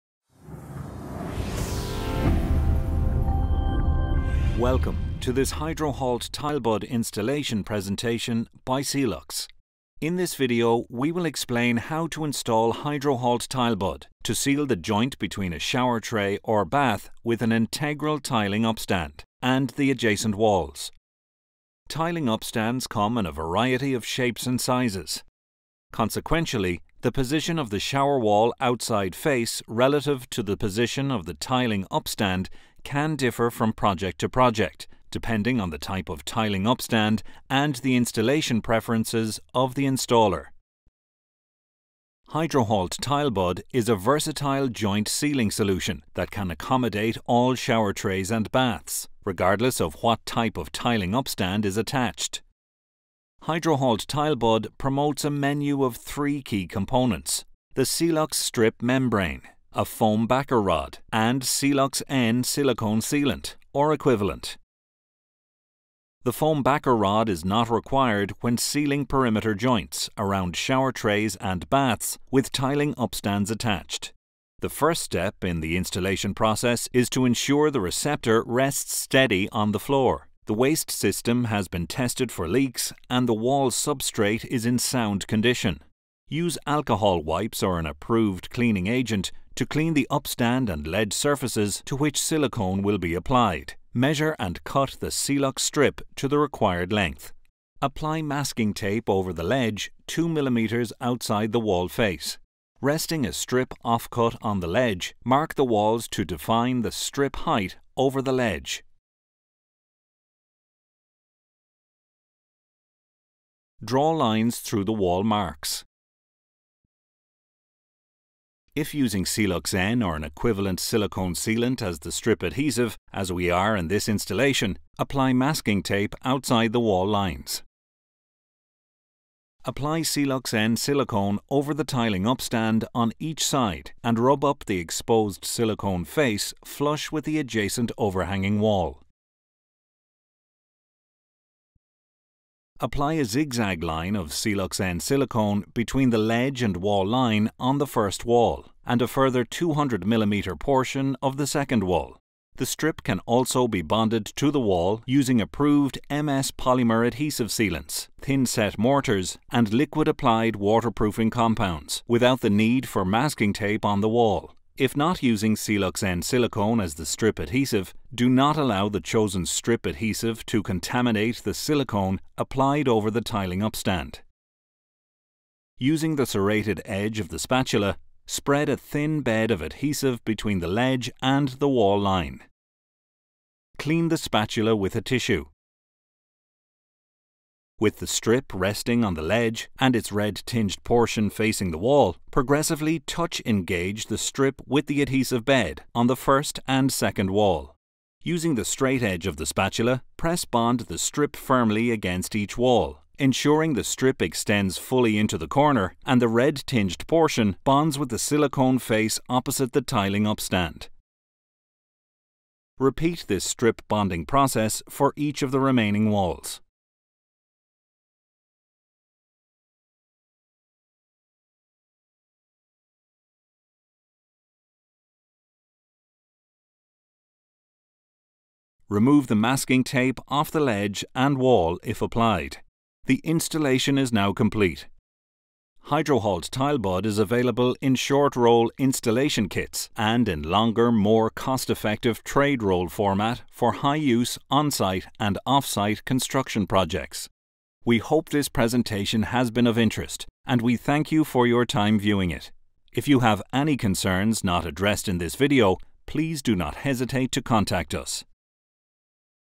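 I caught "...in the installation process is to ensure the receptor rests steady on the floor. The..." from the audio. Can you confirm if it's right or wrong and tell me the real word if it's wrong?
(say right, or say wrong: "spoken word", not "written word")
right.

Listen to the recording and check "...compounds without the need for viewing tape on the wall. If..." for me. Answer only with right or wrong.
wrong.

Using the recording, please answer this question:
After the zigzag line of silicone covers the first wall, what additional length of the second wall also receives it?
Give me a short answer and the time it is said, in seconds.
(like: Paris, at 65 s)
200 mm, at 149 s.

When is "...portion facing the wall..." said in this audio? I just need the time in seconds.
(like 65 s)
190 s.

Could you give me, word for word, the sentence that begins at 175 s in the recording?
Using the serrated edge of the spatula, spread a thin bed of adhesive between the ledge and the wall line.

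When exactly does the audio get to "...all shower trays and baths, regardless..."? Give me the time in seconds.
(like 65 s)
47 s.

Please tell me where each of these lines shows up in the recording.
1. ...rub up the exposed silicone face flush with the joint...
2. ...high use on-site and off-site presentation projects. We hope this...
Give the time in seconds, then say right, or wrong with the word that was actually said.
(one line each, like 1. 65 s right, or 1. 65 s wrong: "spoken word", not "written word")
1. 134 s wrong: "adjacent", not "joint"
2. 243 s wrong: "construction", not "presentation".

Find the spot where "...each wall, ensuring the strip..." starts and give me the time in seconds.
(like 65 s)
202 s.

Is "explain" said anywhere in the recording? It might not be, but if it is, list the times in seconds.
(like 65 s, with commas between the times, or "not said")
11 s.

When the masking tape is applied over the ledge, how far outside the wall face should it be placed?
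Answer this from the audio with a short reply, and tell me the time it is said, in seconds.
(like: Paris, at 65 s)
2 mm, at 100 s.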